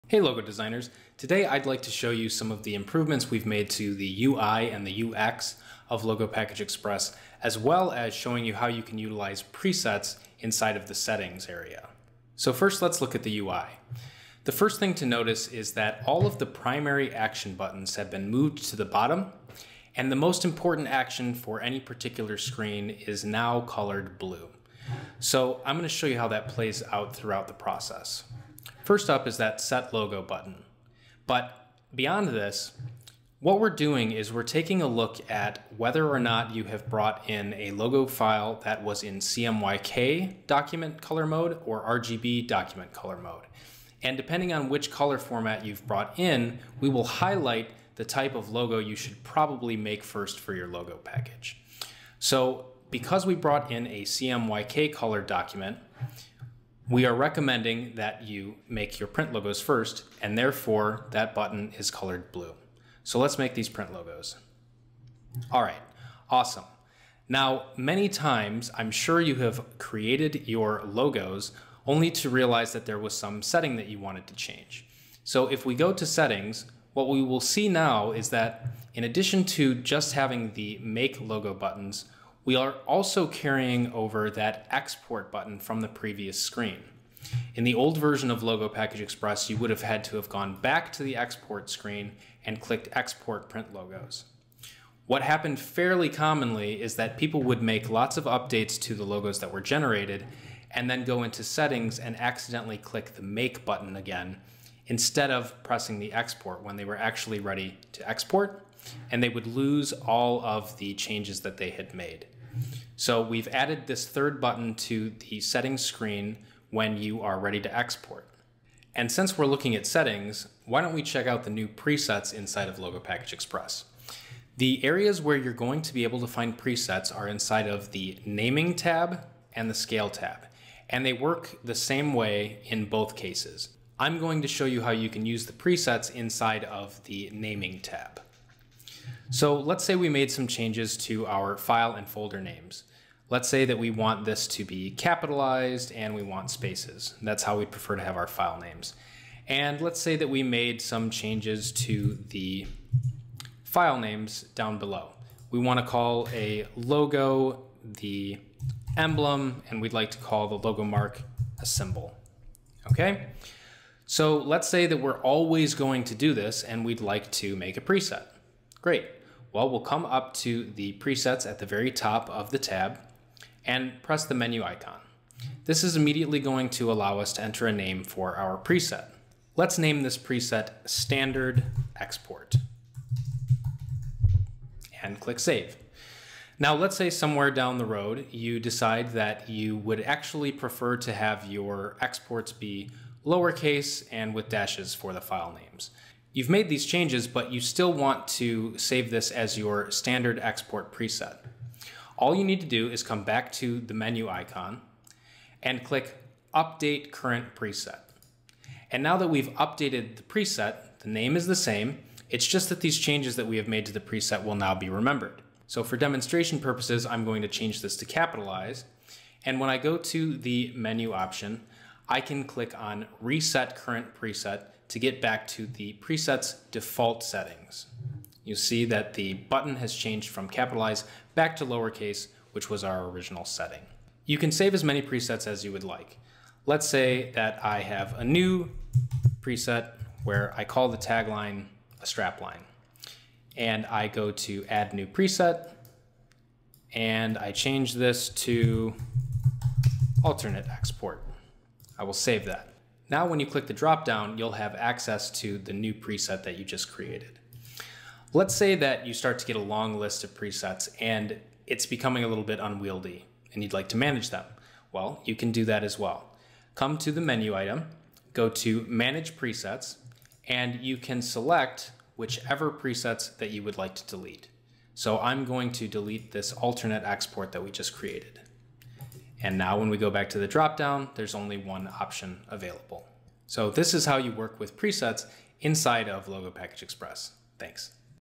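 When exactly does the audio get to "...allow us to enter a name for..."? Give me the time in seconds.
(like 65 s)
176 s.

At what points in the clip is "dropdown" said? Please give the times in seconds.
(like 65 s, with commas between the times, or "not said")
253 s, 280 s.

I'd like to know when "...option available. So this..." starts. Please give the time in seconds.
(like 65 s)
281 s.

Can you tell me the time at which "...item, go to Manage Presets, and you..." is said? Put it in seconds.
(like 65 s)
267 s.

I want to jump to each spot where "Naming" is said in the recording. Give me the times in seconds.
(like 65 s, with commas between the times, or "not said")
128 s, 137 s.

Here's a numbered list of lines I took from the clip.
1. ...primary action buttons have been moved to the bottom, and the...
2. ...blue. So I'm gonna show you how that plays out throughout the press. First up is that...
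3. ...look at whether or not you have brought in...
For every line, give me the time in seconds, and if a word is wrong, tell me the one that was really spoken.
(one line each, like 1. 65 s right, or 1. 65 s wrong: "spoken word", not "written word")
1. 16 s right
2. 24 s wrong: "process", not "press"
3. 34 s right.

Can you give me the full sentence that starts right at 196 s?
You've made these changes, but you still want to save this as your standard export preset.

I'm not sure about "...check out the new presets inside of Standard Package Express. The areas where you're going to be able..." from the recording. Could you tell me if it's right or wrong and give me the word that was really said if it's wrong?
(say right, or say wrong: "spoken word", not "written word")
wrong: "Logo", not "Standard".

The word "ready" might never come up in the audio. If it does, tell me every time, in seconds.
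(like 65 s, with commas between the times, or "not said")
107 s, 117 s.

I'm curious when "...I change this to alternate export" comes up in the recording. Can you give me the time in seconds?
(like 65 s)
247 s.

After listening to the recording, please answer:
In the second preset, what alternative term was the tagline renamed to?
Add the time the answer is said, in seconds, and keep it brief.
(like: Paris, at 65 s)
Strapline, at 242 s.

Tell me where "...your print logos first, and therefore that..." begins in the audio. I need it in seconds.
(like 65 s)
58 s.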